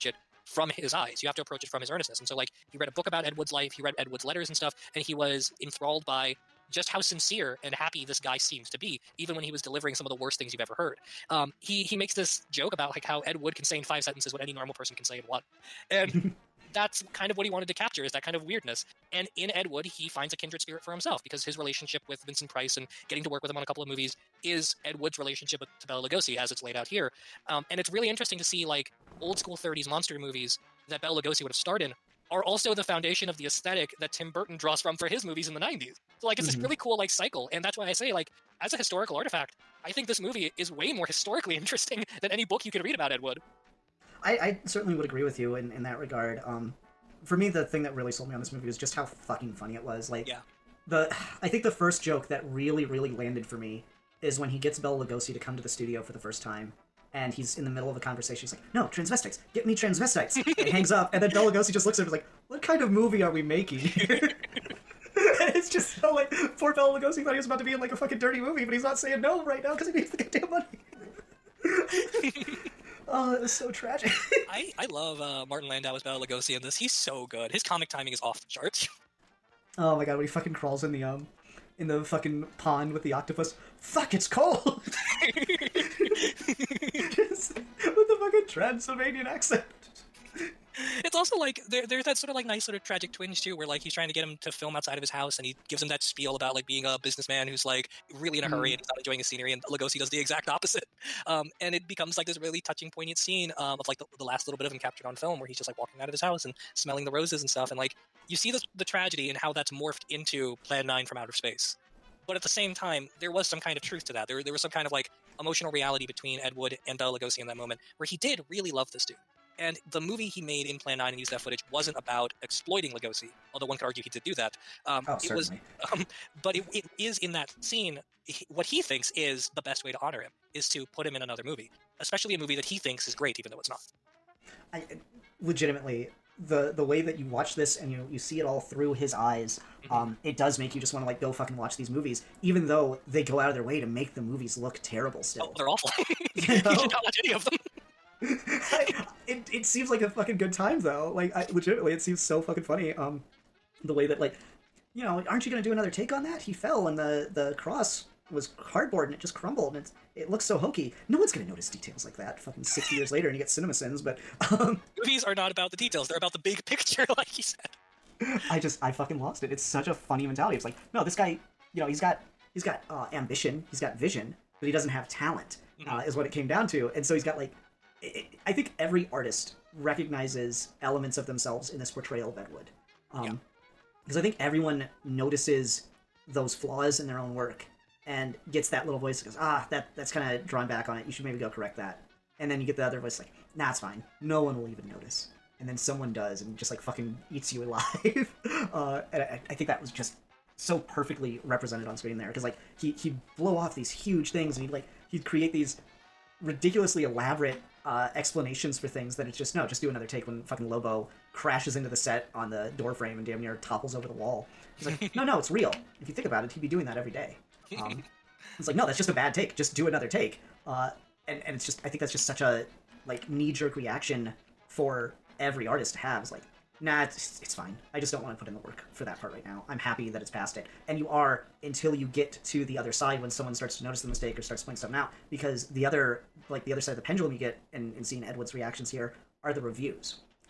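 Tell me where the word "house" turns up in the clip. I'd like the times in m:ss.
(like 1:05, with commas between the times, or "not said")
1:35, 1:46.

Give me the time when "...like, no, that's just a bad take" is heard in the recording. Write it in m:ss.
3:38.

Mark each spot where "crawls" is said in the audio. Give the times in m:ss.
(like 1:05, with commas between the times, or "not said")
1:20.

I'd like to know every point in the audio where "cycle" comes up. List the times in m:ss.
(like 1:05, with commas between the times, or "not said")
0:37.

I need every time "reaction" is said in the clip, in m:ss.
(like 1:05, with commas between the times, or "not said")
3:43, 3:58.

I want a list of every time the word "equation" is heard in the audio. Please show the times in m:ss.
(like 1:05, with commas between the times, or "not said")
not said.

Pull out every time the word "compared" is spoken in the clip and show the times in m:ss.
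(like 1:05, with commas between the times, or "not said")
not said.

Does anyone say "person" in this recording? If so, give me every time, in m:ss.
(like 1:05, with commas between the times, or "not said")
0:14.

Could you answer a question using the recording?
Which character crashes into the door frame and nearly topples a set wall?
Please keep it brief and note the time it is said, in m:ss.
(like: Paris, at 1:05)
Lobo, at 3:30.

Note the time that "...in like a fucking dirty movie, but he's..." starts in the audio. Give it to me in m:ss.
1:07.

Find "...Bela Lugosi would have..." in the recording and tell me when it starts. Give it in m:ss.
0:31.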